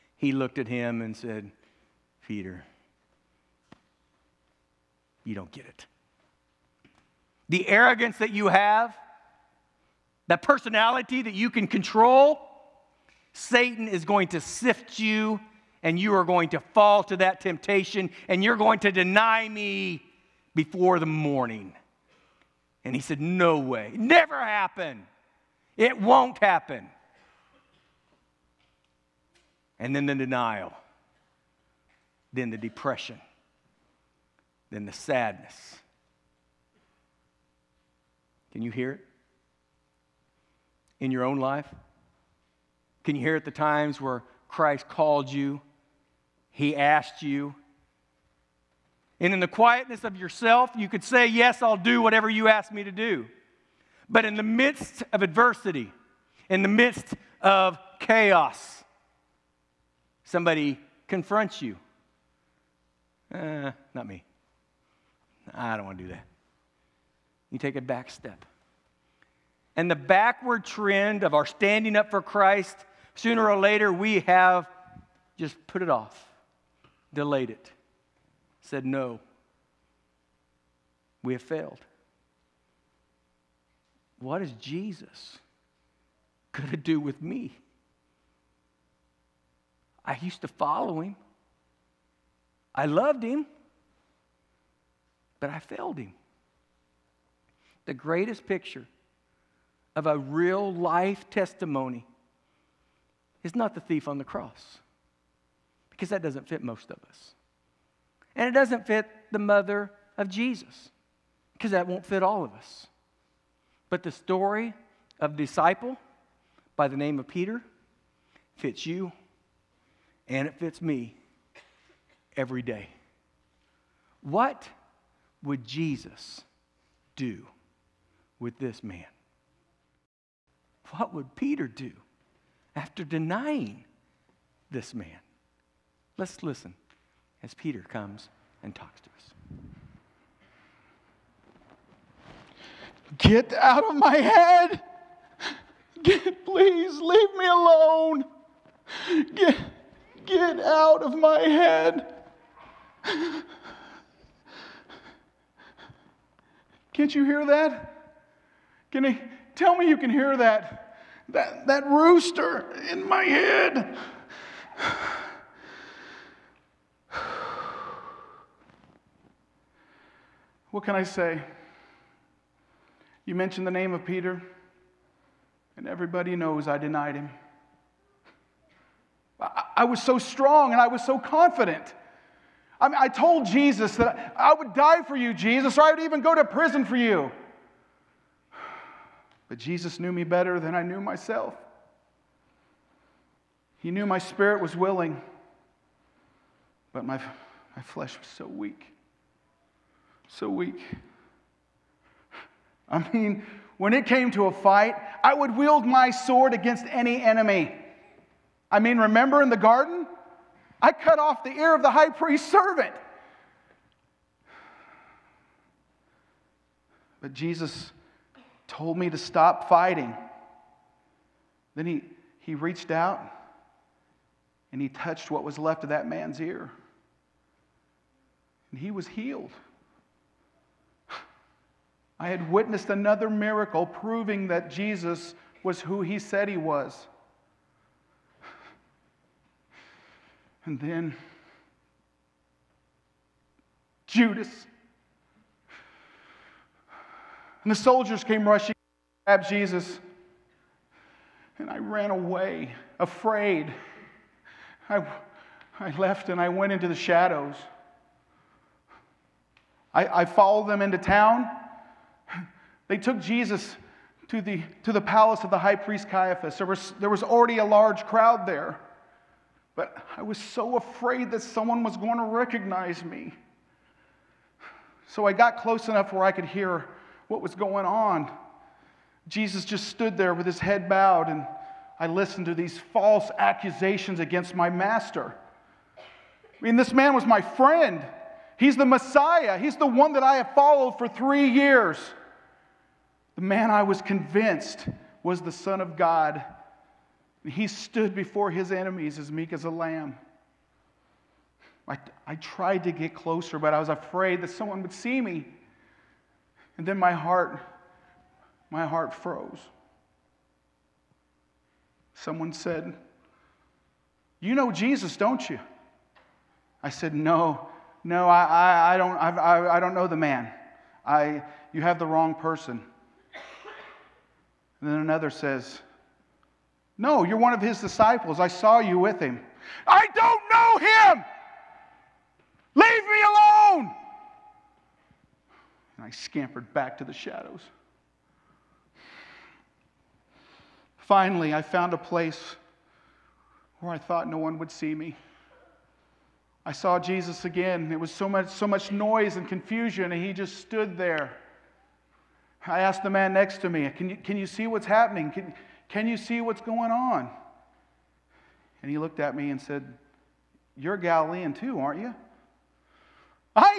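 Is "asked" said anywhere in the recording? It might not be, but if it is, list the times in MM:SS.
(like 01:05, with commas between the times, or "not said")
00:46, 05:52.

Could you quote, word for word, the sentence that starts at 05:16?
I said, No, no, I, I, I don't, I, I don't know the man.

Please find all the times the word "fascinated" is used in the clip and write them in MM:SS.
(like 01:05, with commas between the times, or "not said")
not said.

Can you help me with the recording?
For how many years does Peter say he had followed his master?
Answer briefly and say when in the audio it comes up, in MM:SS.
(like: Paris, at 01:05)
3, at 04:51.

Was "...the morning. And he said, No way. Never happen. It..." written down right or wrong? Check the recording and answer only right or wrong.
right.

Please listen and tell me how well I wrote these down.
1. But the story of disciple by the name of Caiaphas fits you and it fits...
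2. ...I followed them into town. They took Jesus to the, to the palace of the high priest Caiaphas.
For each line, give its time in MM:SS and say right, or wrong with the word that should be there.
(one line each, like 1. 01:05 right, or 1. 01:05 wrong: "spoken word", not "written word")
1. 01:53 wrong: "Peter", not "Caiaphas"
2. 04:20 right.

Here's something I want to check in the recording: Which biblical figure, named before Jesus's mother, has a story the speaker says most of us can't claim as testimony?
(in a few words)
The thief on the cross.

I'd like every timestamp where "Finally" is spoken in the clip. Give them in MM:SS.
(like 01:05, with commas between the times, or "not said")
05:40.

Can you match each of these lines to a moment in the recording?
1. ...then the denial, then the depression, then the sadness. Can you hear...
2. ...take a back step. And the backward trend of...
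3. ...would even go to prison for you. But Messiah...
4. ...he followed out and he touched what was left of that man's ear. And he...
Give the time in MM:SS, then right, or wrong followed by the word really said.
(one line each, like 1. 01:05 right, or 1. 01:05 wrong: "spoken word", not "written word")
1. 00:29 right
2. 01:07 right
3. 03:05 wrong: "Jesus", not "Messiah"
4. 03:42 wrong: "reached", not "followed".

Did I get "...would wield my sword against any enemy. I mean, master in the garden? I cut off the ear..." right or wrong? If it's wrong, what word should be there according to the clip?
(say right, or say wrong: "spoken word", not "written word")
wrong: "remember", not "master".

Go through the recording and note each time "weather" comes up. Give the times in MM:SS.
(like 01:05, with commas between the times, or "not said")
not said.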